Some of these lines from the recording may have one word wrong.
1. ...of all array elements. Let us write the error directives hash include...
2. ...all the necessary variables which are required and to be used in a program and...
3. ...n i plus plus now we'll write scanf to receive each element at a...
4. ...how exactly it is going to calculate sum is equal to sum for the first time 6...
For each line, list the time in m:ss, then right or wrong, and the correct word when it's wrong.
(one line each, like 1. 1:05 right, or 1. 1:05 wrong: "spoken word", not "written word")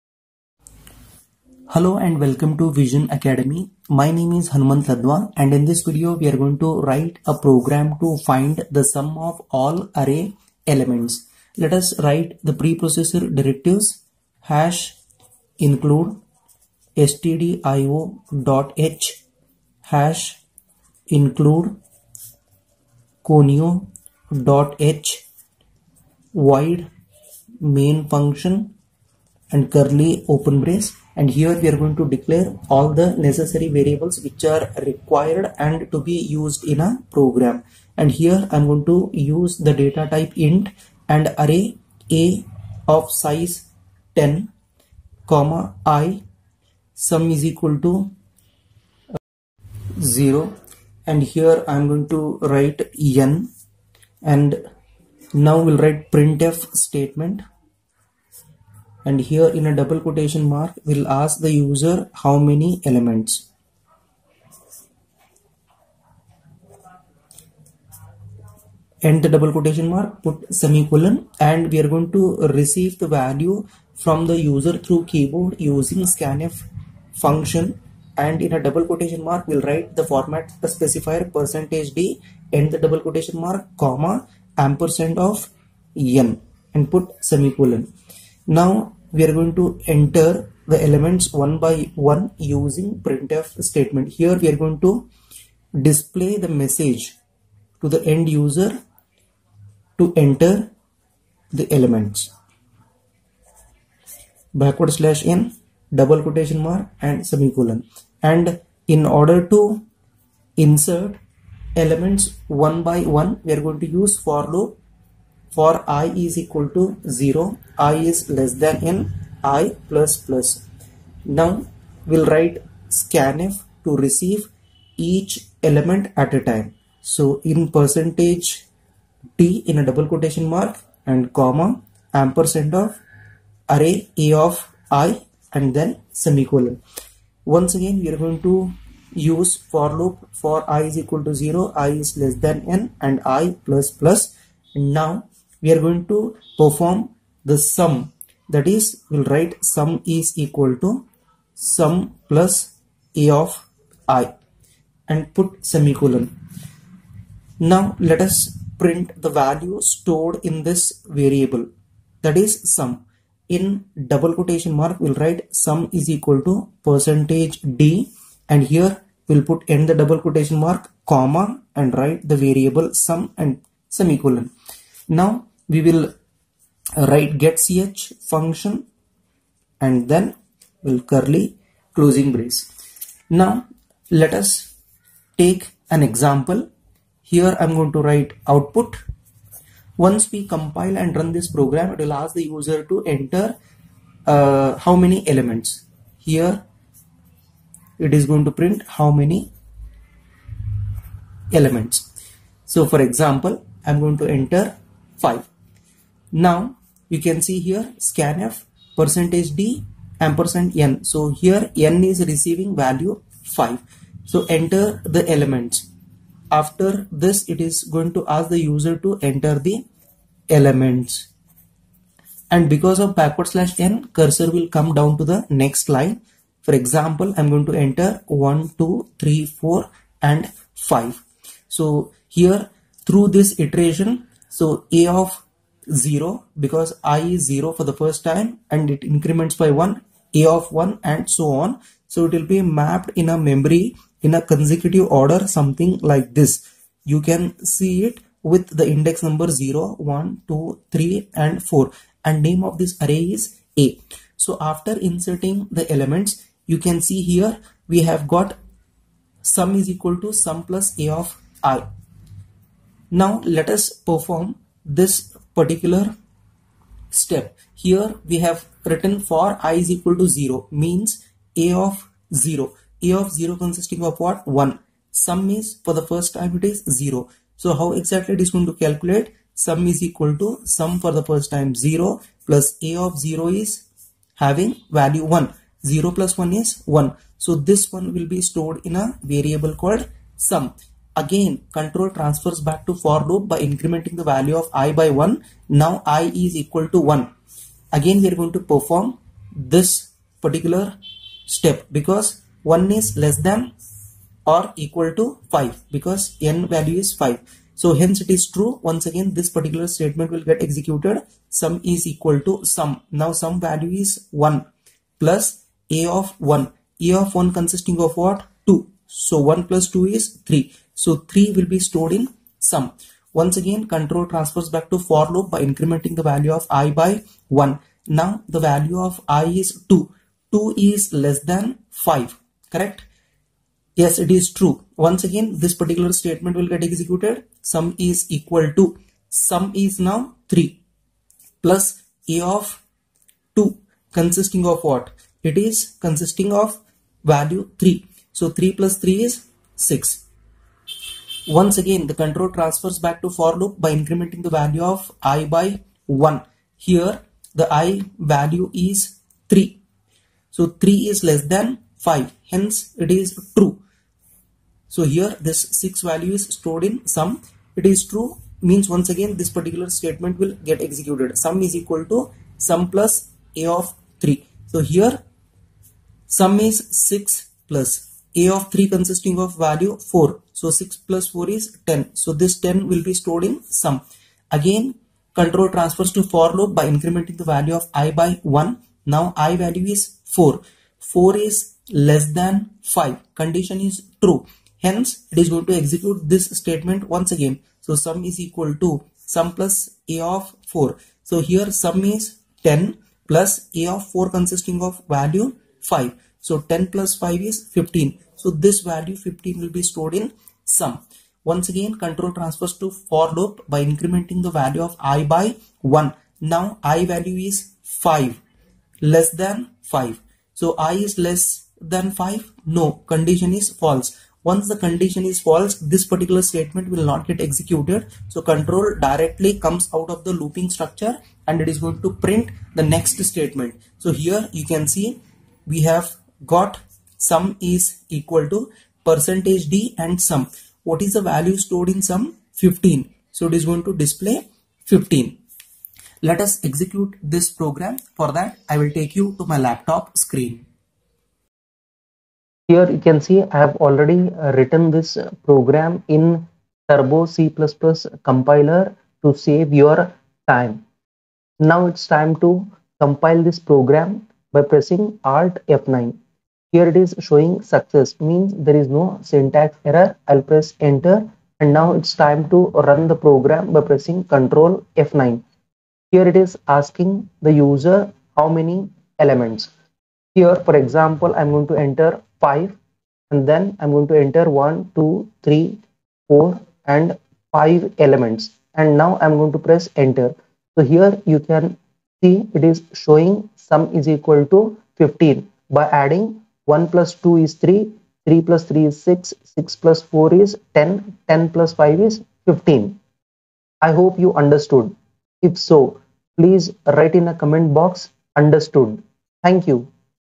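1. 0:09 wrong: "preprocessor", not "error"
2. 0:32 right
3. 1:58 right
4. 4:37 wrong: "0", not "6".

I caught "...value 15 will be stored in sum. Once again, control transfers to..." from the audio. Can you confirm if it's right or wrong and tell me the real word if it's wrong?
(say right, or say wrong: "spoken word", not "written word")
right.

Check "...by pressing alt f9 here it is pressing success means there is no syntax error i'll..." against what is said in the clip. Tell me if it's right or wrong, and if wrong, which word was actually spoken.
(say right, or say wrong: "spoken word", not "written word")
wrong: "showing", not "pressing".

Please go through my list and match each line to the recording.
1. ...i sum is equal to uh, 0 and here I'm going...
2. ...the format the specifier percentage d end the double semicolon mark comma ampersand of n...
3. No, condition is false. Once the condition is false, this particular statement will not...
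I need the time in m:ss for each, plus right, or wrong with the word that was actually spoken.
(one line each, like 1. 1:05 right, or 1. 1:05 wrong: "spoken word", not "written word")
1. 0:45 right
2. 1:19 wrong: "quotation", not "semicolon"
3. 7:02 right.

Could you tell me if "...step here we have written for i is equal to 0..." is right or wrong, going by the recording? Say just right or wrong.
right.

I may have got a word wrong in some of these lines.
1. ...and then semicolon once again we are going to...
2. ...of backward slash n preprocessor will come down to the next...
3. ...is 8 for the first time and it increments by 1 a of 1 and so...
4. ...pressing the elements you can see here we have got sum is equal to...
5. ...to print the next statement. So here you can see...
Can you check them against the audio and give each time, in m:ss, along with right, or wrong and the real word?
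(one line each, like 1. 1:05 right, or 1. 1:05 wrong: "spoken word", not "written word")
1. 2:15 right
2. 3:42 wrong: "cursor", not "preprocessor"
3. 3:57 wrong: "0", not "8"
4. 4:14 wrong: "inserting", not "pressing"
5. 7:12 right.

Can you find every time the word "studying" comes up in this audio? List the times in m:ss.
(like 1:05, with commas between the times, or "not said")
not said.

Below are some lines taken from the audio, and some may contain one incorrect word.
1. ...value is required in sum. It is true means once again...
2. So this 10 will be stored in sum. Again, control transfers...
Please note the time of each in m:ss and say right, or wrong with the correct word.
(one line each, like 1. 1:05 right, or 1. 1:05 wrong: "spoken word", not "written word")
1. 6:06 wrong: "stored", not "required"
2. 6:22 right.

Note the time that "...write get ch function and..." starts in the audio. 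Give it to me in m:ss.
2:57.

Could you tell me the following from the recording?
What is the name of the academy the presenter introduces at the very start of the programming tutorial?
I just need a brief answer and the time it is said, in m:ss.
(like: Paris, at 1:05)
Vision Academy, at 0:02.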